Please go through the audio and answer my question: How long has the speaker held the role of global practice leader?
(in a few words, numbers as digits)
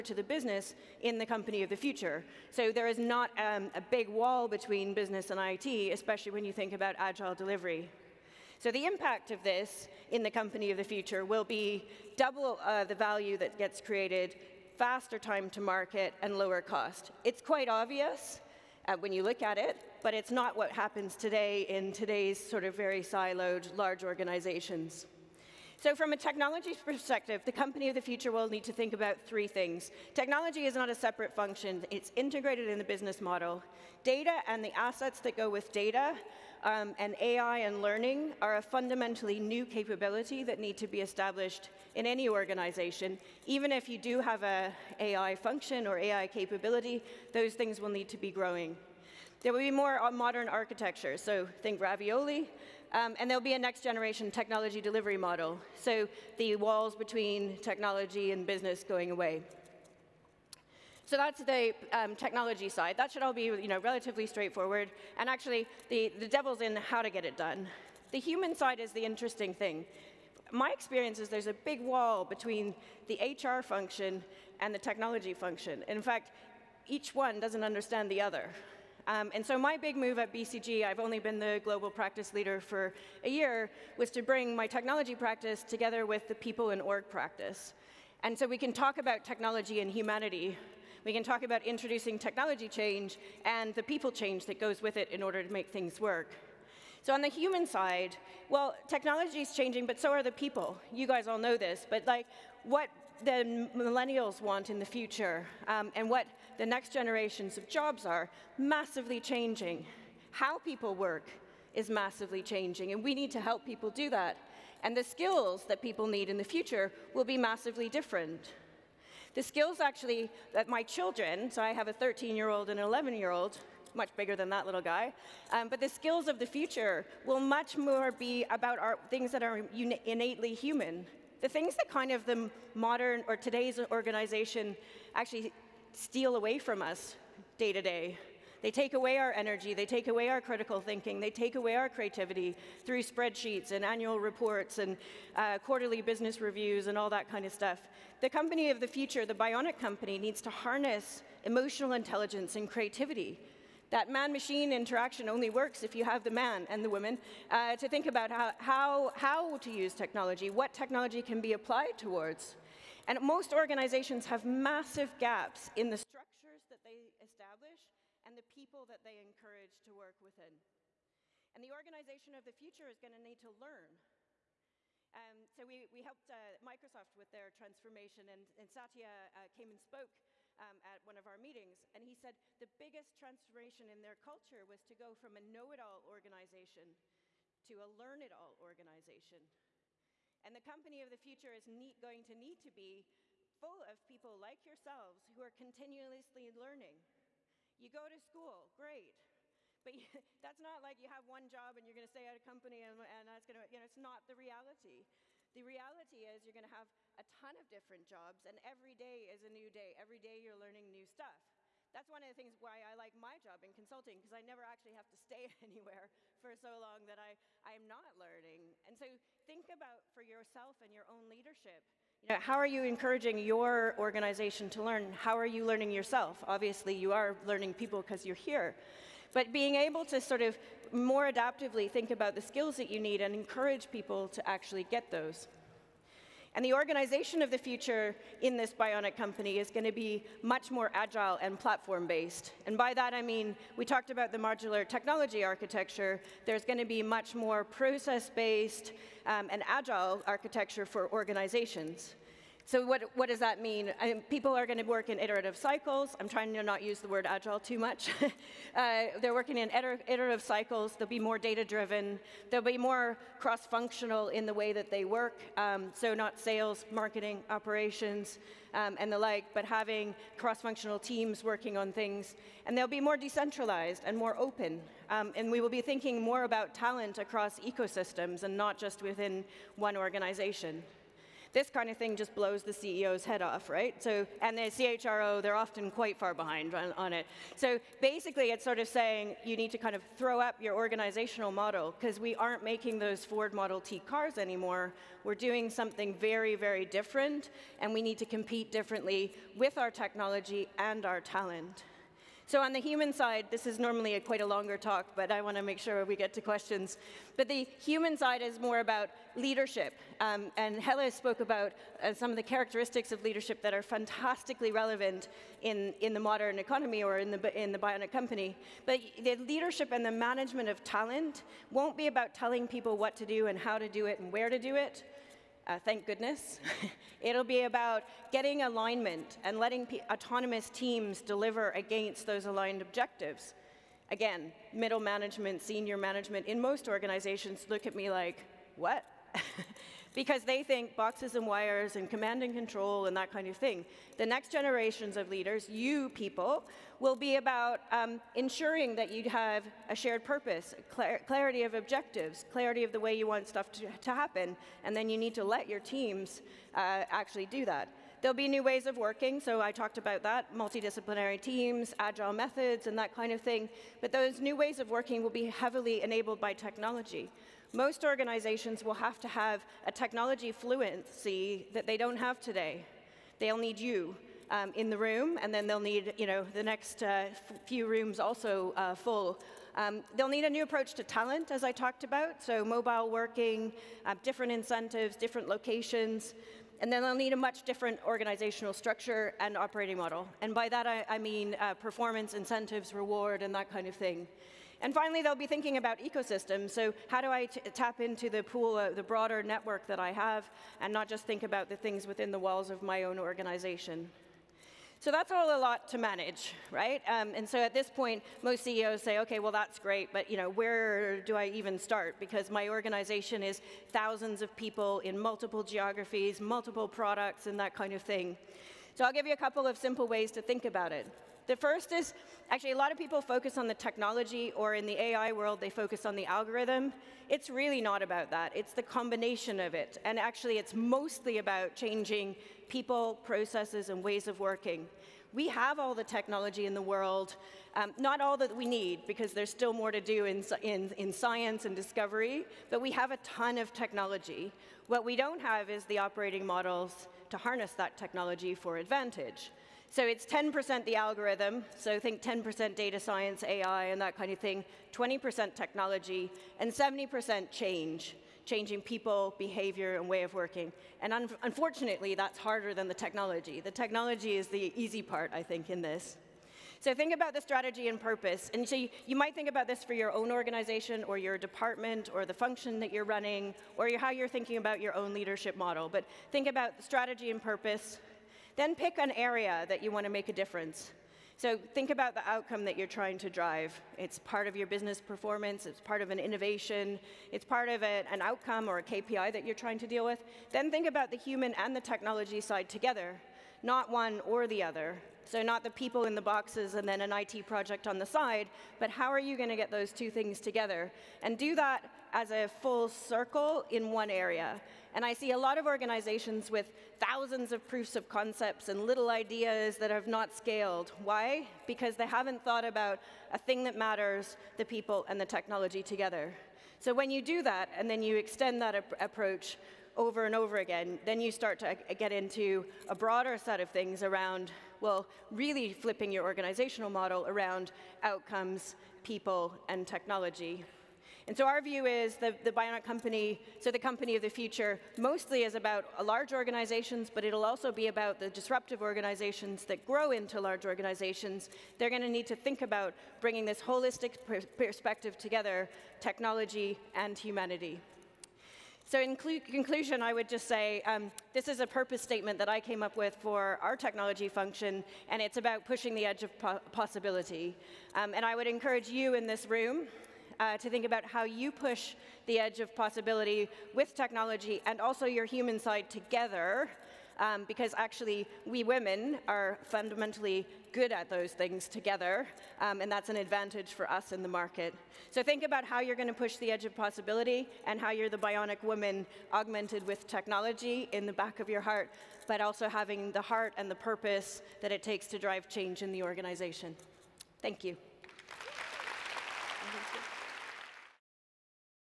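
A year.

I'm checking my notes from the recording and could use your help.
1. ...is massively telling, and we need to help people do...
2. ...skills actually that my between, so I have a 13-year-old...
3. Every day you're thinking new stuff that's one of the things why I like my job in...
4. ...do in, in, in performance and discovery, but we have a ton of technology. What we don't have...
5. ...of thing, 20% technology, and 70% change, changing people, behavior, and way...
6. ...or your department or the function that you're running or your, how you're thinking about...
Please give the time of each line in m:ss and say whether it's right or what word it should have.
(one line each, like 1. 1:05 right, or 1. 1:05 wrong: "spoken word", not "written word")
1. 1:51 wrong: "changing", not "telling"
2. 1:59 wrong: "children", not "between"
3. 3:29 wrong: "learning", not "thinking"
4. 7:19 wrong: "science", not "performance"
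5. 7:34 right
6. 7:51 right.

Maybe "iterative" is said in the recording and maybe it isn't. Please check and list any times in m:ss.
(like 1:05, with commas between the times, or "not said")
4:15, 4:19.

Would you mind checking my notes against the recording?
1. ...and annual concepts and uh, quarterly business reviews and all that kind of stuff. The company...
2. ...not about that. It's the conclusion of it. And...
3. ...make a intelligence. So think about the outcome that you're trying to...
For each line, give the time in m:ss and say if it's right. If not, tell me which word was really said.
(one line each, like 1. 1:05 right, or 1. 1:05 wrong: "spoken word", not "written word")
1. 2:23 wrong: "reports", not "concepts"
2. 7:07 wrong: "combination", not "conclusion"
3. 8:00 wrong: "difference", not "intelligence".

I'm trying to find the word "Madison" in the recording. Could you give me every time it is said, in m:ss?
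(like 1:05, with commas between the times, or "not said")
not said.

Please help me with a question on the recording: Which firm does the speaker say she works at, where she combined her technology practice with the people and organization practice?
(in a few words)
BCG.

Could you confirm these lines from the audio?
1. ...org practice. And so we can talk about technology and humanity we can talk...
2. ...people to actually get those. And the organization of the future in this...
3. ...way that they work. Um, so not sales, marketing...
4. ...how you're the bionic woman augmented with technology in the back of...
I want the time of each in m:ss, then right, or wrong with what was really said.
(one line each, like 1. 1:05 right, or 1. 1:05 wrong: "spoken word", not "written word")
1. 1:26 right
2. 3:53 right
3. 4:24 right
4. 9:37 right.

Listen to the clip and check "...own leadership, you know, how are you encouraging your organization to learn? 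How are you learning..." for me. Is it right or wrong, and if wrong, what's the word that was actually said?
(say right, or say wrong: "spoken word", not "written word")
right.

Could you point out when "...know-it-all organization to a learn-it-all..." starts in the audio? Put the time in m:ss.
3:05.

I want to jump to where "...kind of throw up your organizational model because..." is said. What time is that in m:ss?
4:49.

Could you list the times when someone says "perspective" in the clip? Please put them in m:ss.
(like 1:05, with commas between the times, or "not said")
0:26, 9:04.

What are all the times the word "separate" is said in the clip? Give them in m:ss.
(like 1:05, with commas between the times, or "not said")
0:30.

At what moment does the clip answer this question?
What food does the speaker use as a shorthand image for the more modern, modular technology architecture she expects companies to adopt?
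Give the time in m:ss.
0:51.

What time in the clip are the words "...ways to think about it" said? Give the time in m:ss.
7:00.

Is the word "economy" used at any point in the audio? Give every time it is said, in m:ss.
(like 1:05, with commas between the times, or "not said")
5:16.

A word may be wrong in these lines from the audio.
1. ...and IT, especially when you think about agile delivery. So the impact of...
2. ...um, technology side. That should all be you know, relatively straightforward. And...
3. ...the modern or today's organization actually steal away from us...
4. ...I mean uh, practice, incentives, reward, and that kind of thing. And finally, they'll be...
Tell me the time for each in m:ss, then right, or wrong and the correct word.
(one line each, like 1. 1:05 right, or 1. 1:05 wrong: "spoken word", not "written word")
1. 0:05 right
2. 1:01 right
3. 2:12 right
4. 6:31 wrong: "performance", not "practice".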